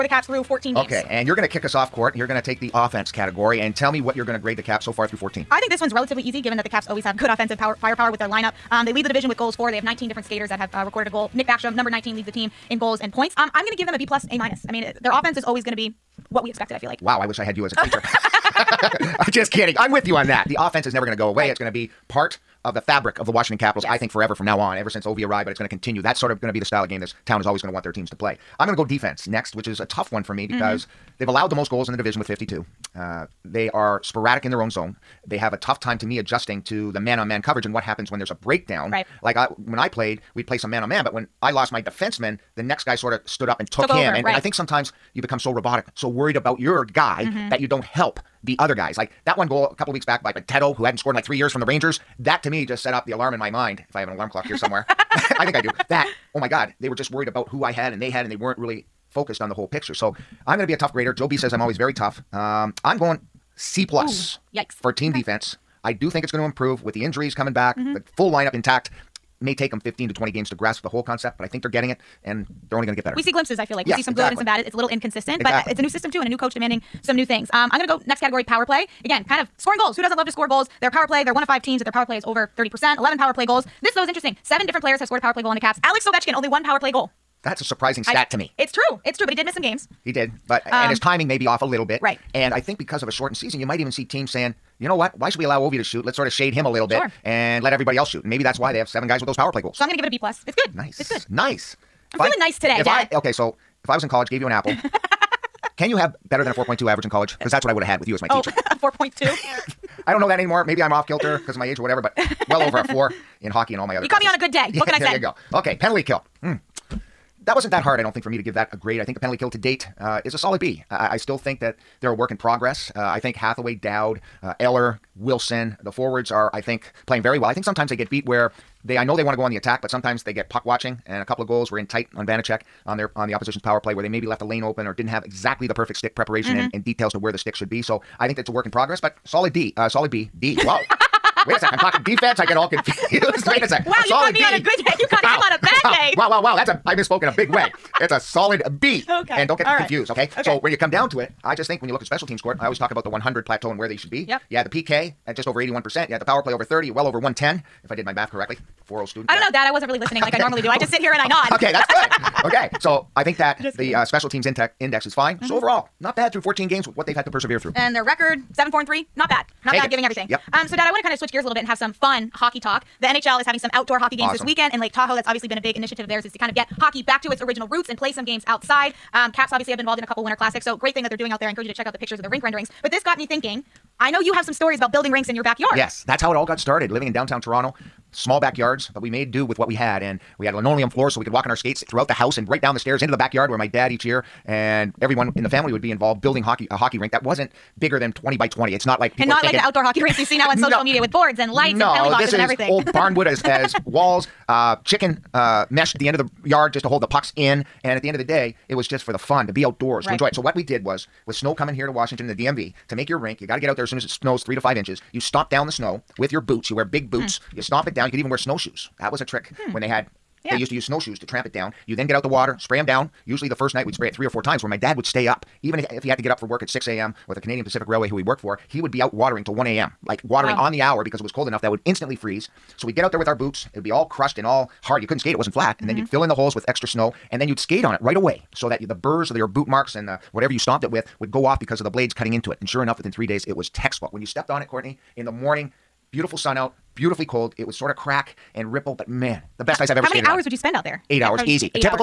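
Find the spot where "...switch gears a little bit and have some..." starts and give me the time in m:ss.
2:51.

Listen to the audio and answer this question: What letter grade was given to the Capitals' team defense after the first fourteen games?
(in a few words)
C plus.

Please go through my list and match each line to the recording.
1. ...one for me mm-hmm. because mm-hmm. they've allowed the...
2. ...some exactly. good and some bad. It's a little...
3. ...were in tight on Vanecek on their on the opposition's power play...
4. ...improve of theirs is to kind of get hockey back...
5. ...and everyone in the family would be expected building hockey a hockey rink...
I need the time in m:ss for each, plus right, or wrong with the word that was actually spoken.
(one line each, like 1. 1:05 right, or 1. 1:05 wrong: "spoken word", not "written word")
1. 0:30 right
2. 1:14 right
3. 2:11 right
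4. 2:55 wrong: "initiative", not "improve"
5. 3:14 wrong: "involved", not "expected".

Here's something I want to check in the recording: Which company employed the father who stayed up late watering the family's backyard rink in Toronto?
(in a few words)
Canadian Pacific Railway.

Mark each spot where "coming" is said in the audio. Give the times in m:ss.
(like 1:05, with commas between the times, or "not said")
1:07, 3:31.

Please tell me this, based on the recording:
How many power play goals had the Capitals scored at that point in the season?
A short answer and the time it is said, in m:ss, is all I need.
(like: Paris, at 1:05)
11, at 1:22.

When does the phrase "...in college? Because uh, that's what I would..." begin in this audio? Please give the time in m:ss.
1:47.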